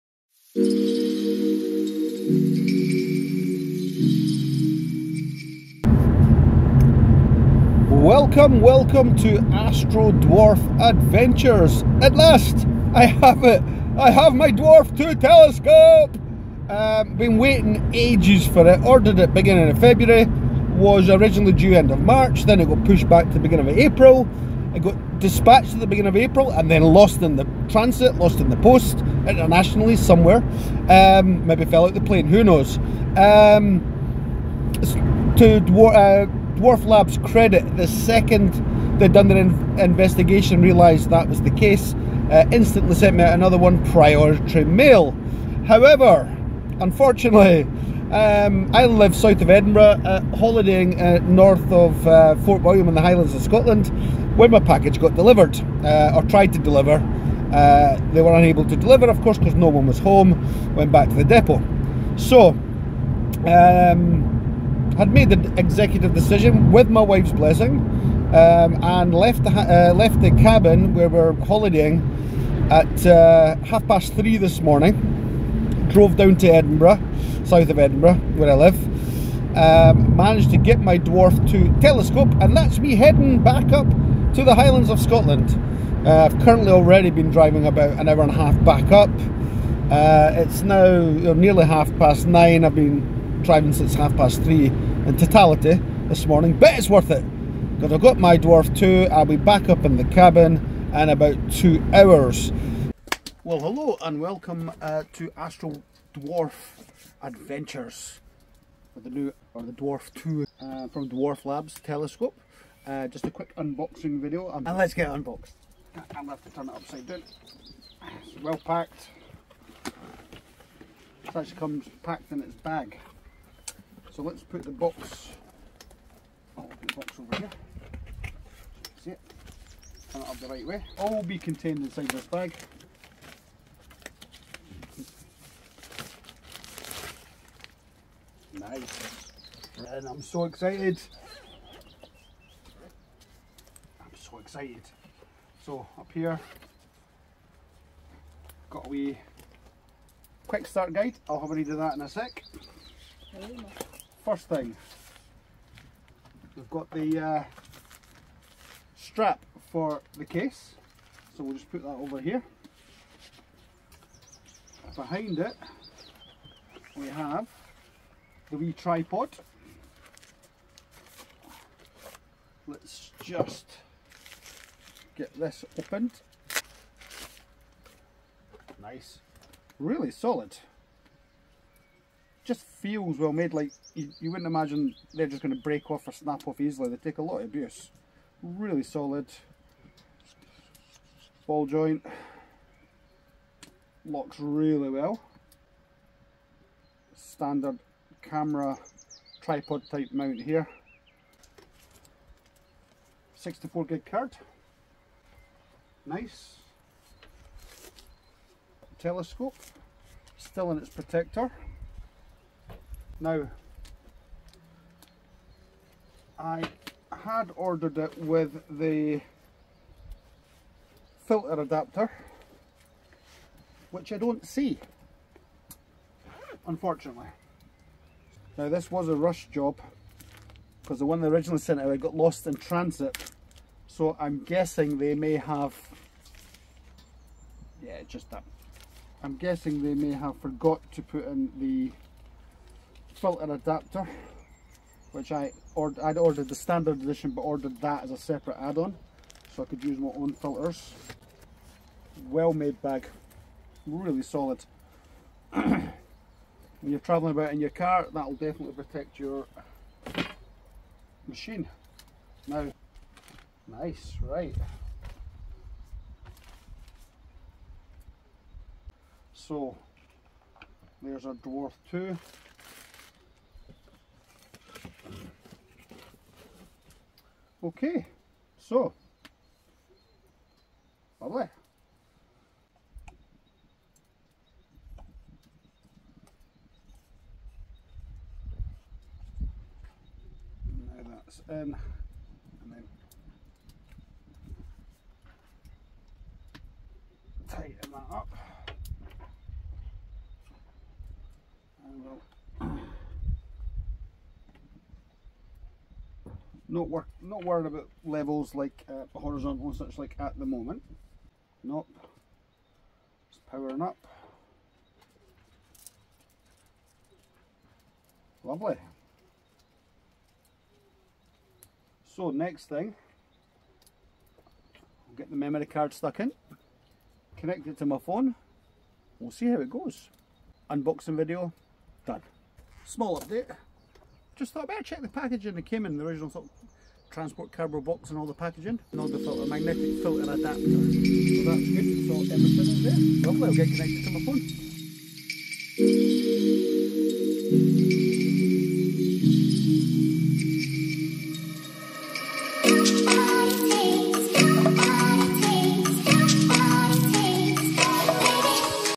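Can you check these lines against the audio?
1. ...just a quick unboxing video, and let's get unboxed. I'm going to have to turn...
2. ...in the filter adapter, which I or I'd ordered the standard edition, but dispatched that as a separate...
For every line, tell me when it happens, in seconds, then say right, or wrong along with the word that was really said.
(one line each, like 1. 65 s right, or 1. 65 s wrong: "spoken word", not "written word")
1. 113 s right
2. 241 s wrong: "ordered", not "dispatched".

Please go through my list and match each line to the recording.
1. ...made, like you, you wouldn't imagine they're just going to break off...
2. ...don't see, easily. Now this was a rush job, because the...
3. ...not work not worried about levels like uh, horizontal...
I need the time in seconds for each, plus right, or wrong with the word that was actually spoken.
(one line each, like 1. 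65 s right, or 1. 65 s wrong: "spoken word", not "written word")
1. 183 s right
2. 224 s wrong: "unfortunately", not "easily"
3. 306 s right.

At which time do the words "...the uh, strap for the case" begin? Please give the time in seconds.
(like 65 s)
156 s.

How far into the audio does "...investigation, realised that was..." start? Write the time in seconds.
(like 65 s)
39 s.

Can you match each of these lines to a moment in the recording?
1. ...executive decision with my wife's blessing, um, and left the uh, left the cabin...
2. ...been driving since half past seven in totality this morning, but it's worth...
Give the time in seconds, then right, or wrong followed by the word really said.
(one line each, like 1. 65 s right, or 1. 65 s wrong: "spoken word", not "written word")
1. 65 s right
2. 92 s wrong: "three", not "seven".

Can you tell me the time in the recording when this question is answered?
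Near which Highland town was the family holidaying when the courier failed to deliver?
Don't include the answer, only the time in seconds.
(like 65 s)
52 s.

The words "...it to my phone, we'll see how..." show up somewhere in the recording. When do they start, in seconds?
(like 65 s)
327 s.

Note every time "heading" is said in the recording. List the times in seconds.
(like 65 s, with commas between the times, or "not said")
82 s.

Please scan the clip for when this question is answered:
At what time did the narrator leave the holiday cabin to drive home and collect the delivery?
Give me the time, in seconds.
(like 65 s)
73 s.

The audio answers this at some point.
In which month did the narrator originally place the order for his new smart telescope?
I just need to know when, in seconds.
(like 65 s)
19 s.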